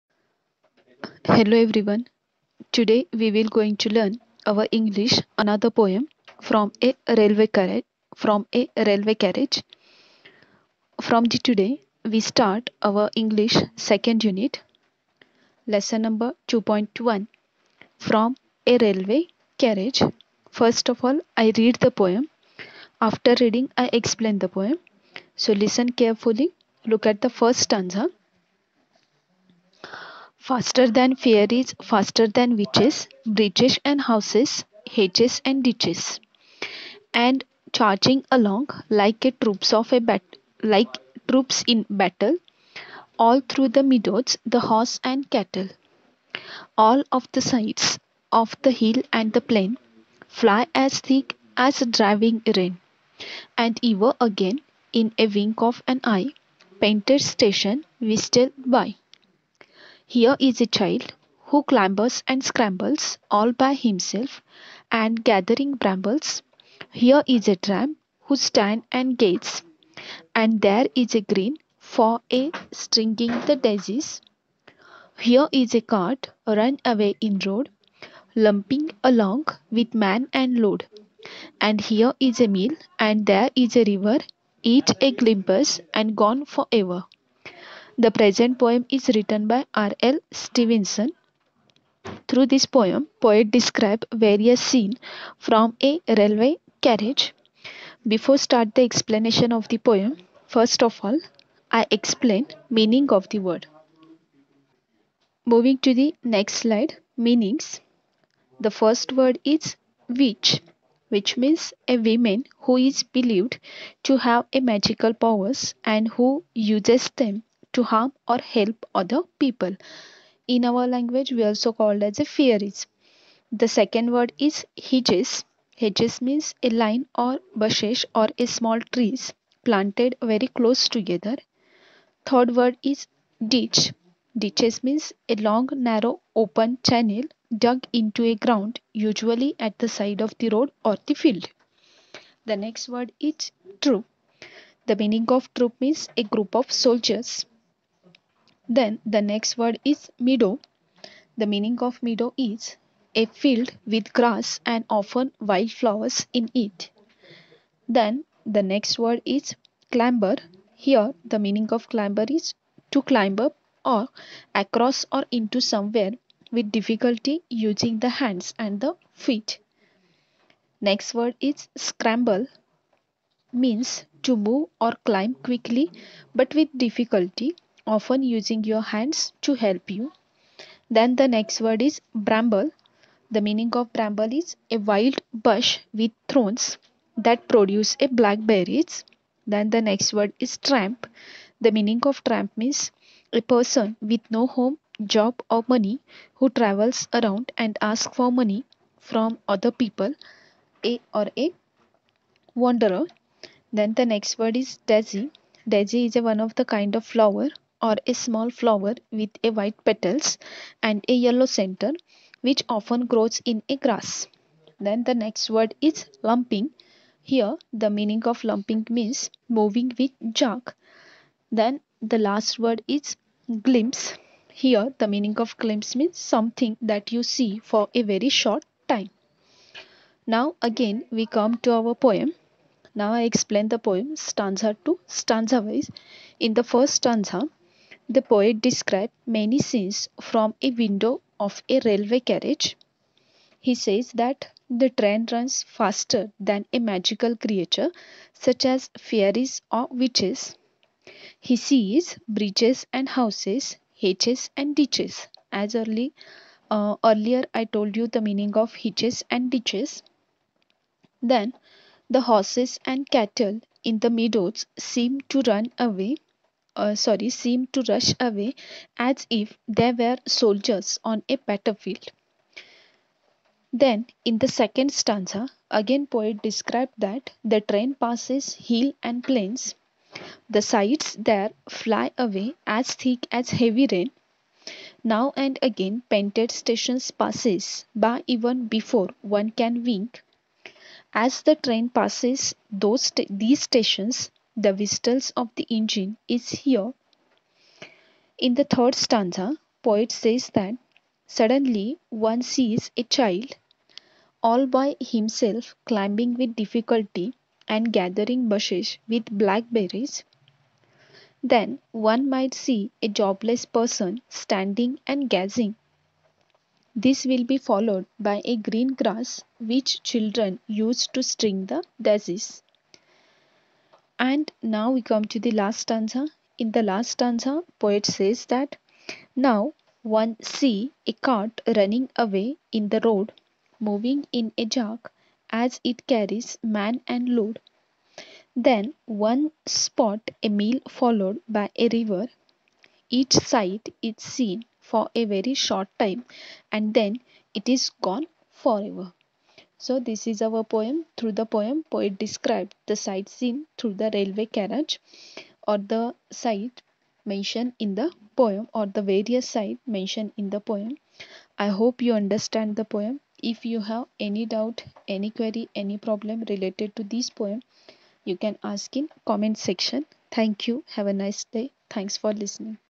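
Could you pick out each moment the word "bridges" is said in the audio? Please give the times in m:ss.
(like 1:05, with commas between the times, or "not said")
0:33, 4:12.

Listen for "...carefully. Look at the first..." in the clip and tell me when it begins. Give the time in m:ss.
0:25.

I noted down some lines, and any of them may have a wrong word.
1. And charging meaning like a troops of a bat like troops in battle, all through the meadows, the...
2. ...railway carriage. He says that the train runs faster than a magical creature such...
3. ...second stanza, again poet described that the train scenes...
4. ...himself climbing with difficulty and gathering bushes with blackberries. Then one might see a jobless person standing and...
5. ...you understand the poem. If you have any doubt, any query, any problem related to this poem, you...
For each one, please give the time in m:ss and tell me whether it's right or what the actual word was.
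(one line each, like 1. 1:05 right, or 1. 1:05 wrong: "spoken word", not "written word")
1. 0:37 wrong: "along", not "meaning"
2. 4:01 right
3. 4:34 wrong: "passes", not "scenes"
4. 5:04 right
5. 6:02 right.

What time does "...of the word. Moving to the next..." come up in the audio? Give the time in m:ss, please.
1:43.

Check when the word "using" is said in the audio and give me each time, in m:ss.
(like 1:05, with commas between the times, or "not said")
2:47, 2:58.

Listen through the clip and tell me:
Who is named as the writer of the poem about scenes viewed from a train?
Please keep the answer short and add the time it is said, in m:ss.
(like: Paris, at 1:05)
R. L. Stevenson, at 1:29.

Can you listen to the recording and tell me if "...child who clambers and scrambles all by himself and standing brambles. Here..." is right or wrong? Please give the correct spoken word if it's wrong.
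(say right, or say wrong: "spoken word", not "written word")
wrong: "gathering", not "standing".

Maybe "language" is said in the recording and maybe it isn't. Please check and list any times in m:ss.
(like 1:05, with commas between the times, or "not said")
2:00.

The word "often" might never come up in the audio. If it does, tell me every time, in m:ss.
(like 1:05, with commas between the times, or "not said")
2:34, 2:57, 3:32.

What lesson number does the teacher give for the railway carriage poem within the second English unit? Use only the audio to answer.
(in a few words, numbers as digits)
2.1.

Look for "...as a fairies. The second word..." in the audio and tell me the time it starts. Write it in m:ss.
2:02.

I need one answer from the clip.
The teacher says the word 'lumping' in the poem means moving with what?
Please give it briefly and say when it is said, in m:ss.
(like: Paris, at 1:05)
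jerk, at 3:40.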